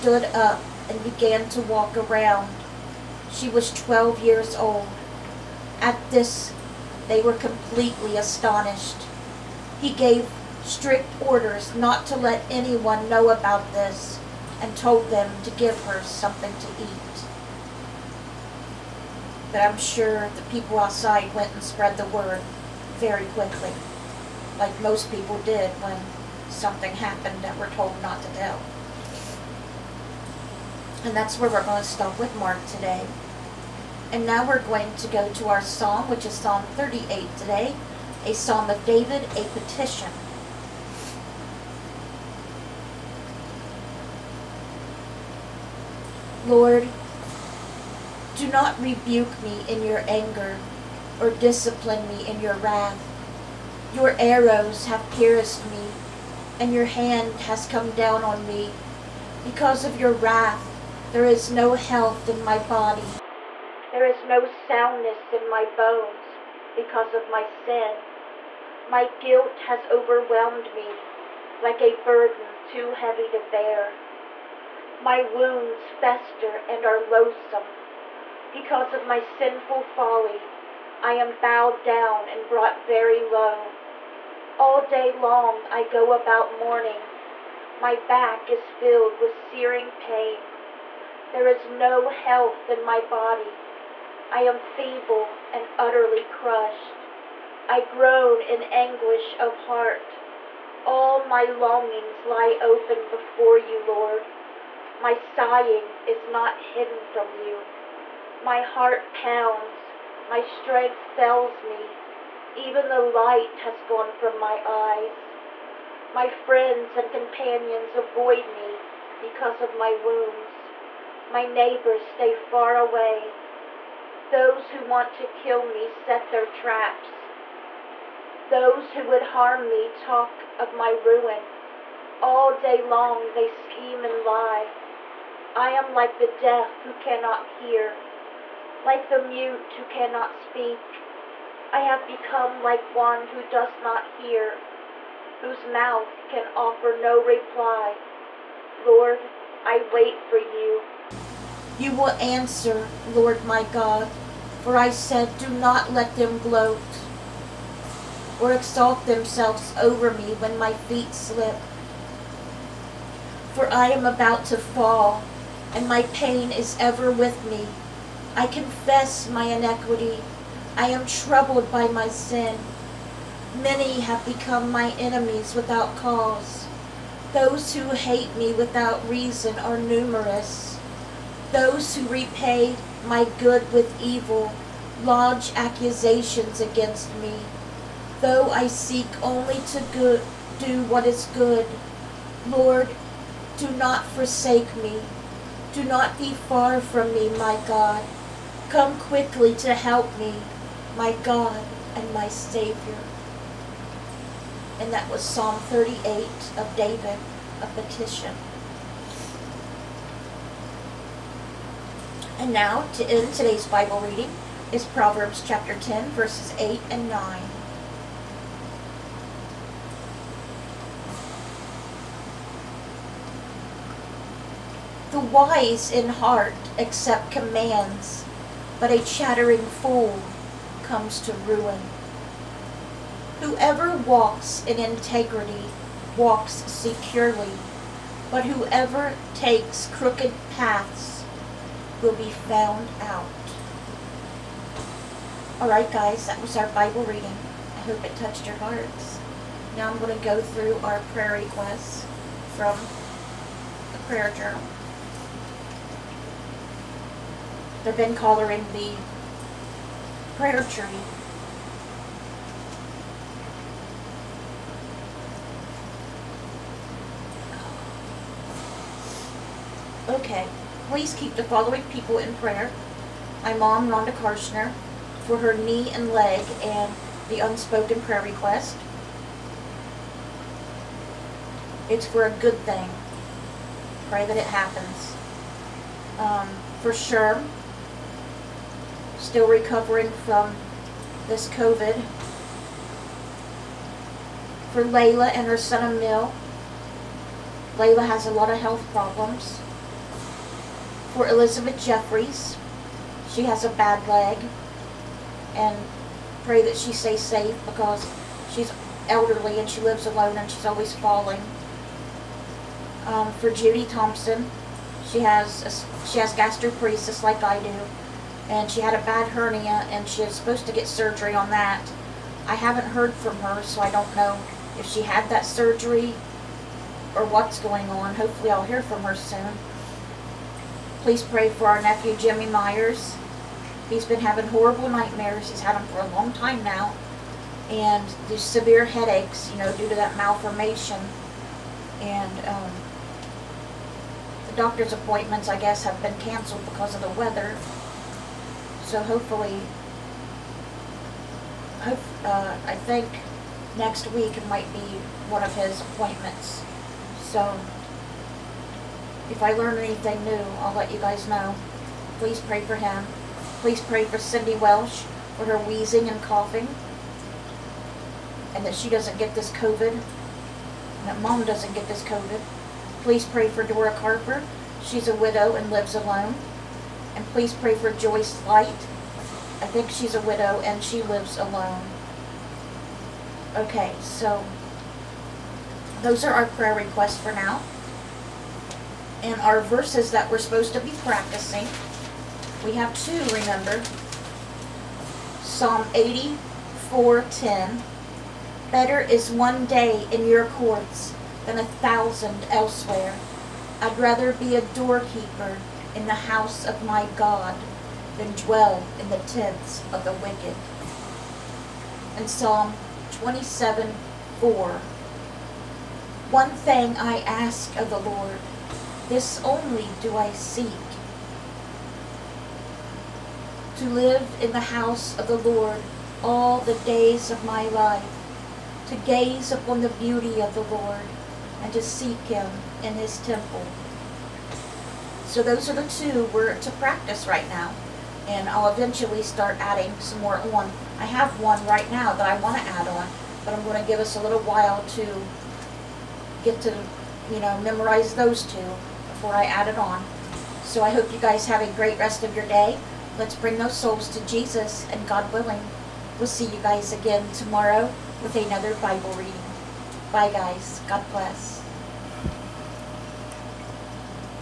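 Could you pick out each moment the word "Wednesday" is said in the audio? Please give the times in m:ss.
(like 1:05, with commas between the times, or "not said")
not said.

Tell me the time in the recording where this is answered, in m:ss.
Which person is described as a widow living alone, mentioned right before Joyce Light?
6:13.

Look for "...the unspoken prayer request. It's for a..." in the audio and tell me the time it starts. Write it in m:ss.
4:37.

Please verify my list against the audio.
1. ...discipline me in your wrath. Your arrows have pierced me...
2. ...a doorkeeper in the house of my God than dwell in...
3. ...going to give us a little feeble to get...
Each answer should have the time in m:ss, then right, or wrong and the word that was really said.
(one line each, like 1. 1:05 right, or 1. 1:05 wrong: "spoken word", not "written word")
1. 0:51 right
2. 6:44 right
3. 7:23 wrong: "while", not "feeble".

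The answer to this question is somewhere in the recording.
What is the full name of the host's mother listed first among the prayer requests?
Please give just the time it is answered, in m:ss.
4:33.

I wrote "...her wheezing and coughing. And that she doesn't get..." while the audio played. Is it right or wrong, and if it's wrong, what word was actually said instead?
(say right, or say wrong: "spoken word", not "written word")
right.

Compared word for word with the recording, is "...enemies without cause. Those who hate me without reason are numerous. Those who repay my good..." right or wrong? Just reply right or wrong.
right.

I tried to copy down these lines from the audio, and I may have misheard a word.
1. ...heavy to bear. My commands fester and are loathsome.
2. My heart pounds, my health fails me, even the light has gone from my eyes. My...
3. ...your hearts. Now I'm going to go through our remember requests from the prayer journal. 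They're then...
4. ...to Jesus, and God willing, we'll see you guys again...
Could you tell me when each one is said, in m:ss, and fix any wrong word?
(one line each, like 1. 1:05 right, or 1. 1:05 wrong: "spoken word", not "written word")
1. 1:12 wrong: "wounds", not "commands"
2. 1:48 wrong: "strength", not "health"
3. 4:08 wrong: "prayer", not "remember"
4. 7:34 right.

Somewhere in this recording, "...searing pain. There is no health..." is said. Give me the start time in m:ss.
1:29.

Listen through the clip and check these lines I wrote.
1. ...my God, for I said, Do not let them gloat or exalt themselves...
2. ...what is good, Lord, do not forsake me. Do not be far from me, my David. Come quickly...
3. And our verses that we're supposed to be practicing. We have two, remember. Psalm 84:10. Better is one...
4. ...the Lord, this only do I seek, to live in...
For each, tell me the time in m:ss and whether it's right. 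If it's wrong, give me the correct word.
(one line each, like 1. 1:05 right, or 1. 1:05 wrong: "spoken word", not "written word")
1. 2:33 right
2. 3:10 wrong: "God", not "David"
3. 6:29 right
4. 6:57 right.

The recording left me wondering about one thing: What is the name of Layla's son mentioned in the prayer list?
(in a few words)
Emil.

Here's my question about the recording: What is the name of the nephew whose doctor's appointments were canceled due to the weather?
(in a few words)
Jimmy Myers.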